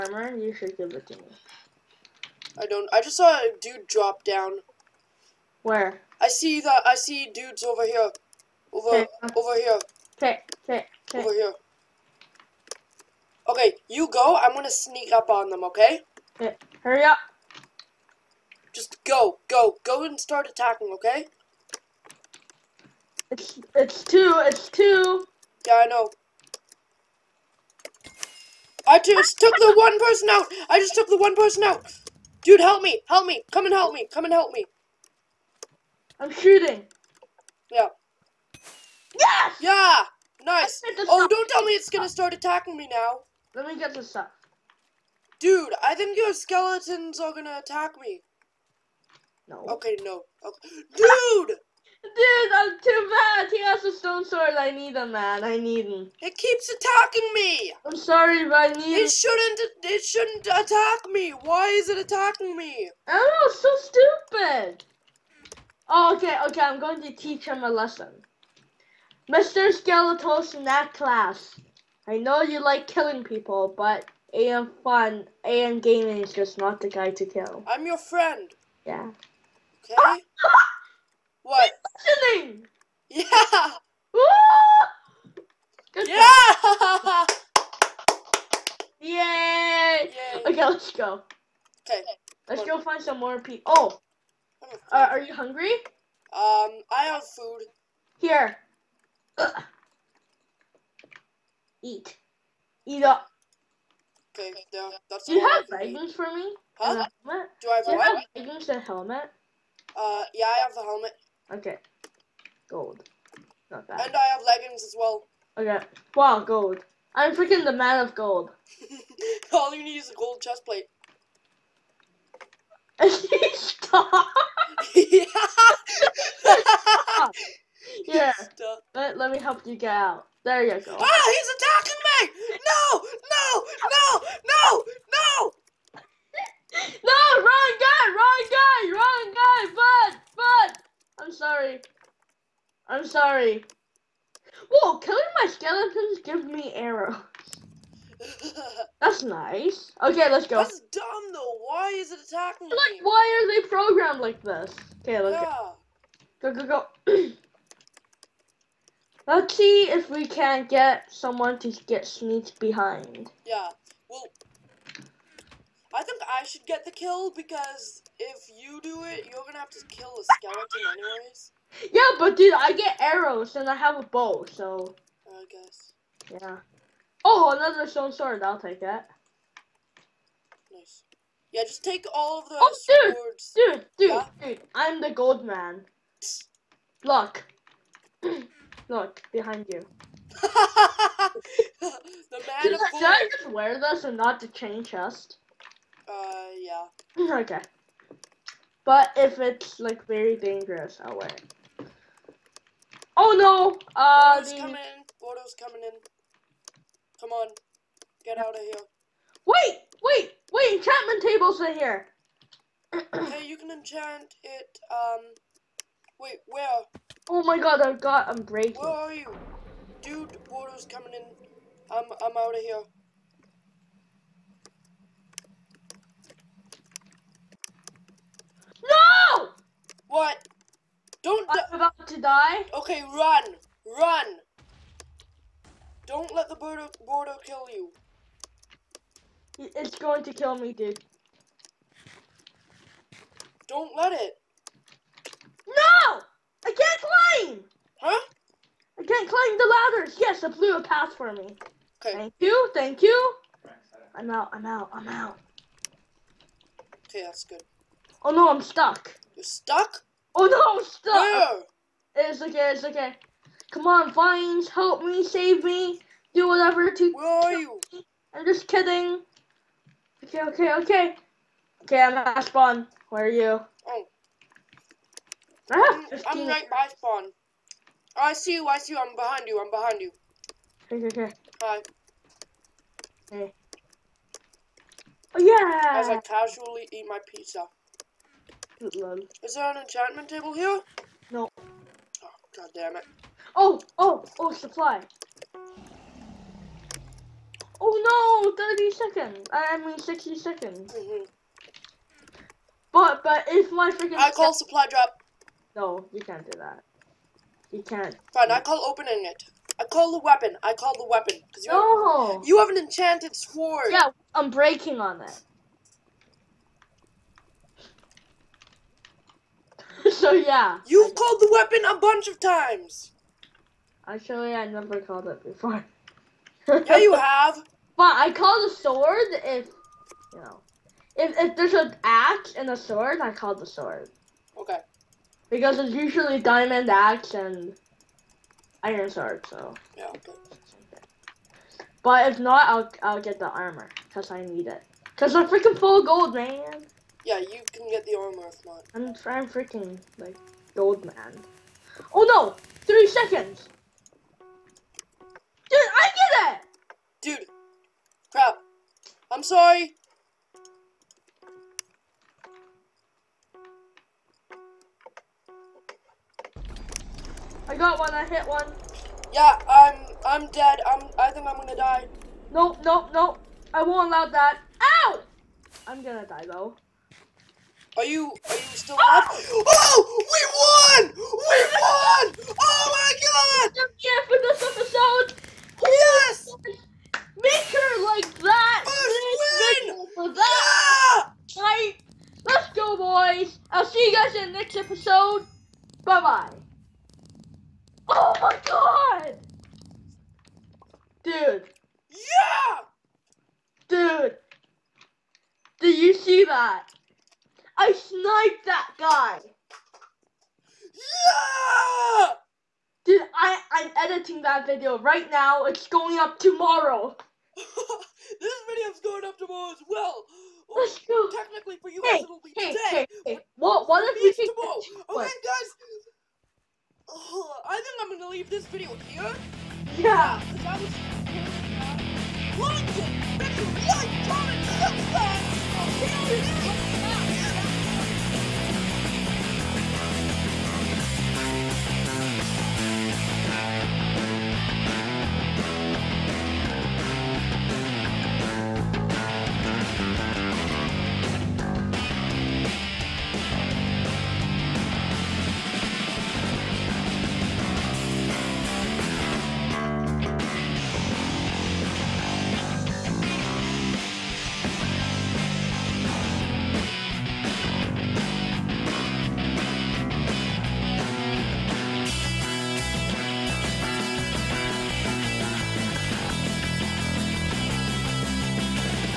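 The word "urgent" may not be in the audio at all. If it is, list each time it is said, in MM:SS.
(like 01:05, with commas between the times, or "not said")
not said.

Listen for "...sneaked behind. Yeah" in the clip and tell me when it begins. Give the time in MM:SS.
02:42.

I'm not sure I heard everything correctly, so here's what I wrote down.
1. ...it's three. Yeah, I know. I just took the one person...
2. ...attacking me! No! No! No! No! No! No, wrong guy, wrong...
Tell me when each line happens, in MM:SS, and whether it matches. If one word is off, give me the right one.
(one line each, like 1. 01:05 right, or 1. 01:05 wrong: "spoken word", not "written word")
1. 00:24 wrong: "two", not "three"
2. 02:11 right.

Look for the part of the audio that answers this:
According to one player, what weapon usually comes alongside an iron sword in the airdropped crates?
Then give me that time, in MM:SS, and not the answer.
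05:36.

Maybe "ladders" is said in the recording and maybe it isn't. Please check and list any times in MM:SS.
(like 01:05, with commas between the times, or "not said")
04:09.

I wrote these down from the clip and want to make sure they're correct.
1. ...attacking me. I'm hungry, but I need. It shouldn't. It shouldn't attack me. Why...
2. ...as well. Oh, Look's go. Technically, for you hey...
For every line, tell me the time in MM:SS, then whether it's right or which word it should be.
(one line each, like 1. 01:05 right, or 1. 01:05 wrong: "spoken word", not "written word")
1. 00:56 wrong: "sorry", not "hungry"
2. 06:59 wrong: "Let", not "Look".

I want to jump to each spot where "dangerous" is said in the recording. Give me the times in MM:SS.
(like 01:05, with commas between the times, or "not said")
03:20.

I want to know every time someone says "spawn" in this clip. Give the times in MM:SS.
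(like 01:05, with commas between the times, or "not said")
04:32, 04:36.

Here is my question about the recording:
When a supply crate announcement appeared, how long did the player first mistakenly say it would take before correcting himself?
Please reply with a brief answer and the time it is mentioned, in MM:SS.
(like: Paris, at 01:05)
30 seconds, at 04:58.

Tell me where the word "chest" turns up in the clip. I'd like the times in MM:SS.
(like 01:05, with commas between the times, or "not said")
02:00, 03:14.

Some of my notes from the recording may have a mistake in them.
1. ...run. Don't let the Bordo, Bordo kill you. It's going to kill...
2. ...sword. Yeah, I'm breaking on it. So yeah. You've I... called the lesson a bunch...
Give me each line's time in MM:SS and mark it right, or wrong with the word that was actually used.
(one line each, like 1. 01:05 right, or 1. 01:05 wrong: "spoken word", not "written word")
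1. 03:53 right
2. 05:13 wrong: "weapon", not "lesson".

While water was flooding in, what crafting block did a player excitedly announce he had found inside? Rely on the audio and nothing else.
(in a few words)
Enchantment table.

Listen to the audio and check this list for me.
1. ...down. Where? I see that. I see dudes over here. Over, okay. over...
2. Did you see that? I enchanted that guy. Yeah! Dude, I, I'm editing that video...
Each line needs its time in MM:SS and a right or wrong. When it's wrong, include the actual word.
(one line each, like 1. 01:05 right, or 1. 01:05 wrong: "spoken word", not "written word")
1. 00:04 right
2. 06:45 wrong: "sniped", not "enchanted".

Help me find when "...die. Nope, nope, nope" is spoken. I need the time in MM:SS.
06:11.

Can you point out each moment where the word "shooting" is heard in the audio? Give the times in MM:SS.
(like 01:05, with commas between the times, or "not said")
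00:36.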